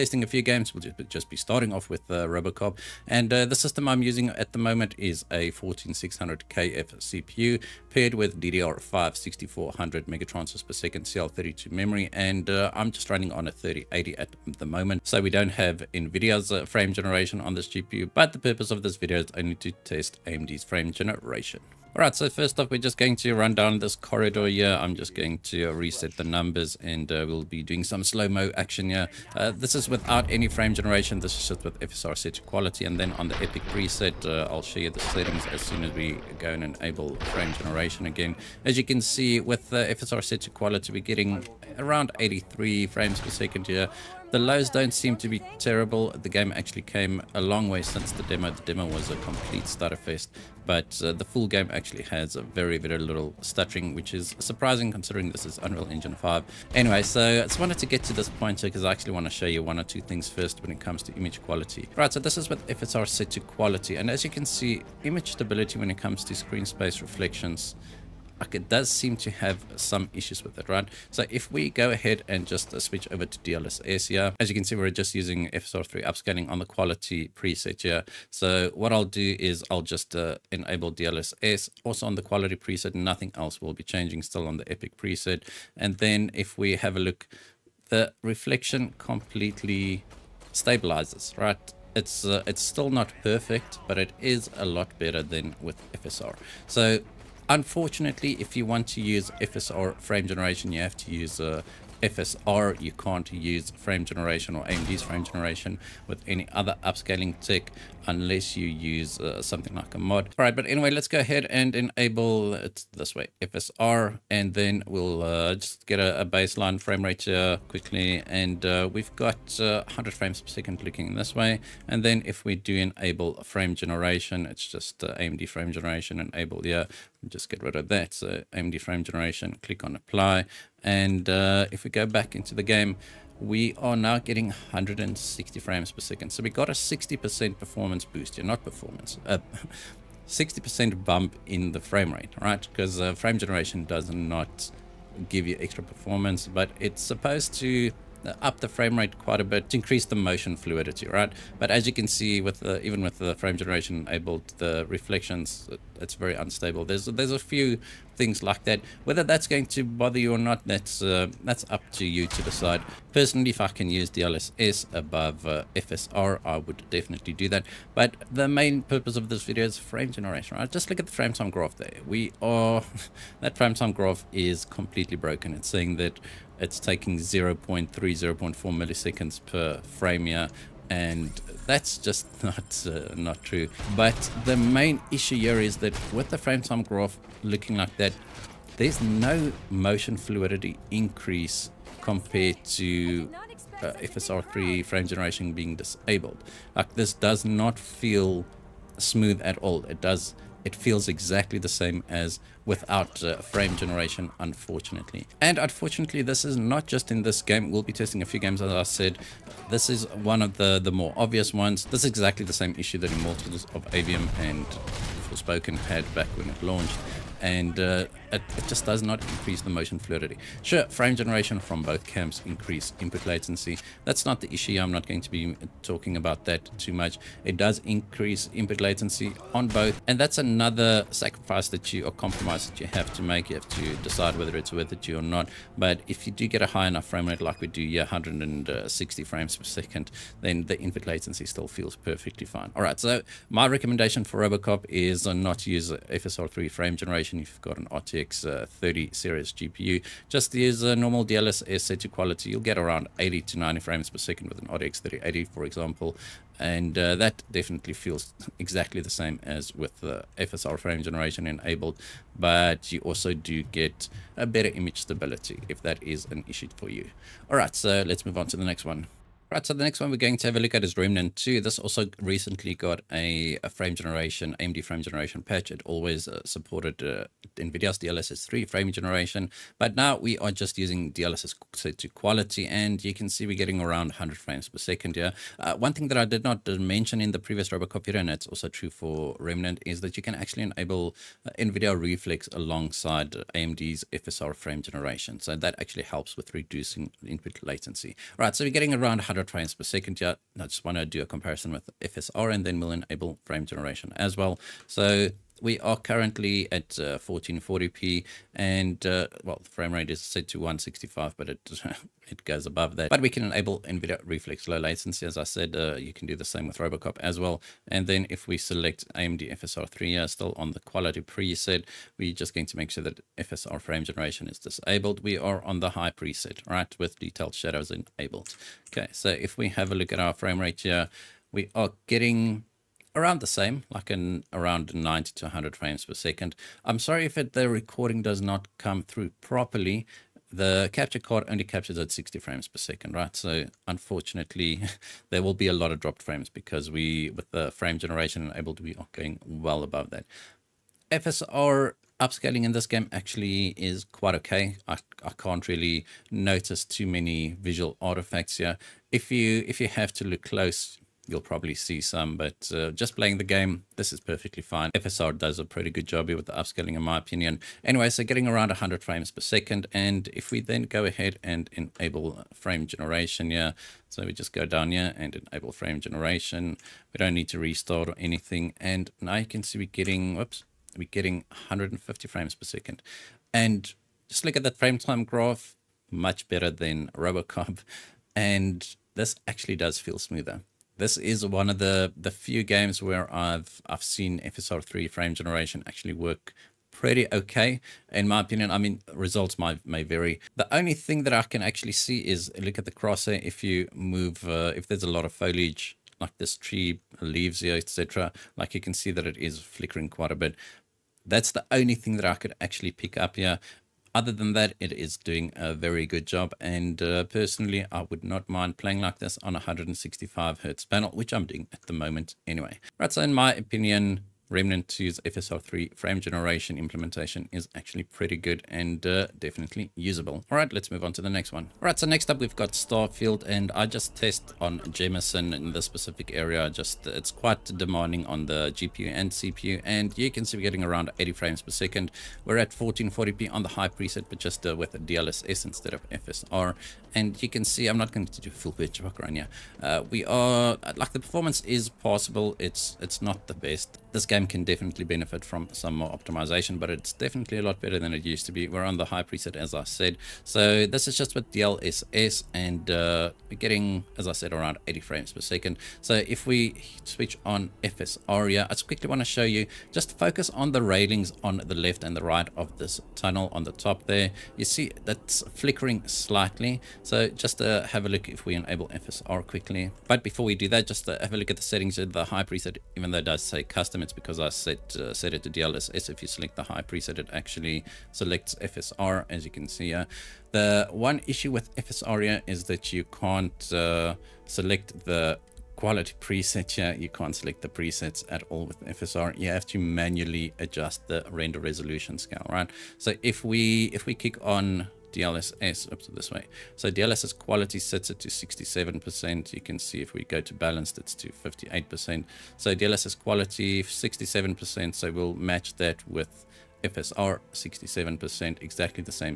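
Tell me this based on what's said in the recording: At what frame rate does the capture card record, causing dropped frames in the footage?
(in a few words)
60 frames per second.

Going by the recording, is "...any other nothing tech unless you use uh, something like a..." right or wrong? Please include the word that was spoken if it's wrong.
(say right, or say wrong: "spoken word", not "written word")
wrong: "upscaling", not "nothing".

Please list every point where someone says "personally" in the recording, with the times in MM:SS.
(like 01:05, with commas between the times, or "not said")
02:43, 06:57.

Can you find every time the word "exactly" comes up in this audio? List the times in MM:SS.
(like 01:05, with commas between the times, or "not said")
03:21, 03:32, 04:18, 08:38.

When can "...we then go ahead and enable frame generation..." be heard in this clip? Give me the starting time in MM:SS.
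06:10.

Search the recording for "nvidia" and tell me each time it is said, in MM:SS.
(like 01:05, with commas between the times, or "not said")
00:15, 04:37, 04:51, 05:13.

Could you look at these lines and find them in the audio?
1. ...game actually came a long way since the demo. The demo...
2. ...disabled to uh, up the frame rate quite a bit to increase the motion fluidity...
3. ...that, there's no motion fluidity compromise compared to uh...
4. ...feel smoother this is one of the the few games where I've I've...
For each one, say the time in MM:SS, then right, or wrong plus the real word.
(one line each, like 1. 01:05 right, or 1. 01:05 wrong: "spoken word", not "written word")
1. 00:46 right
2. 02:27 wrong: "supposed", not "disabled"
3. 03:07 wrong: "increase", not "compromise"
4. 06:29 right.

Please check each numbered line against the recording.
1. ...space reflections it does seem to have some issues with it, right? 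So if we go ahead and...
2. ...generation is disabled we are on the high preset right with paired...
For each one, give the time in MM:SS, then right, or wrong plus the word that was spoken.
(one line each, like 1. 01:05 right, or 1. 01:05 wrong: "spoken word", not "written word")
1. 01:06 right
2. 05:24 wrong: "detailed", not "paired".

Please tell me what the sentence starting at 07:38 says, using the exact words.
We're on the high preset, as I said.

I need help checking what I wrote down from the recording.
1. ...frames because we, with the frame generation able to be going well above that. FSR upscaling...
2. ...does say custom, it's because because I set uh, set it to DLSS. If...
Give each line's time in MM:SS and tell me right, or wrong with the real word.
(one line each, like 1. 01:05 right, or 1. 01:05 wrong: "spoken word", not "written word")
1. 05:46 right
2. 08:03 right.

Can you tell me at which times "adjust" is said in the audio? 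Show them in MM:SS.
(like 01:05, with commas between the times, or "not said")
08:20.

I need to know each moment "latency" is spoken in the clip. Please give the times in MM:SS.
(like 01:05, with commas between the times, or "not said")
03:43, 03:48, 04:01, 04:57, 05:14.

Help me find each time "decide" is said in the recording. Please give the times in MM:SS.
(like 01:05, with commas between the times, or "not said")
02:42, 03:53.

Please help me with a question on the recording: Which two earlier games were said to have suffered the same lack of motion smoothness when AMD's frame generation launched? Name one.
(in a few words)
Immortals of Aveum.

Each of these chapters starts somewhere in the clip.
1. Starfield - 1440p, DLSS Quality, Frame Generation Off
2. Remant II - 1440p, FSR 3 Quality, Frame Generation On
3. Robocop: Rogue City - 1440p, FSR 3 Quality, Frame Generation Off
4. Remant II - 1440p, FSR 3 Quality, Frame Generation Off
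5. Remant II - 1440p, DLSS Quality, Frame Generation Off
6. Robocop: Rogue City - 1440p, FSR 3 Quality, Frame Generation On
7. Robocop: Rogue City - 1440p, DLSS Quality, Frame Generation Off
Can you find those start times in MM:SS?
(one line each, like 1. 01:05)
1. 07:11
2. 06:17
3. 00:22
4. 05:29
5. 04:28
6. 02:12
7. 01:29.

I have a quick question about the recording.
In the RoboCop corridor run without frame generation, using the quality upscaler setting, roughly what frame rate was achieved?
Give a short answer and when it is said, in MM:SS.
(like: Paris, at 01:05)
83, at 00:42.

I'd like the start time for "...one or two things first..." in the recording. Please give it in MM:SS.
00:59.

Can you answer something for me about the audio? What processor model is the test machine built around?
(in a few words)
14600KF.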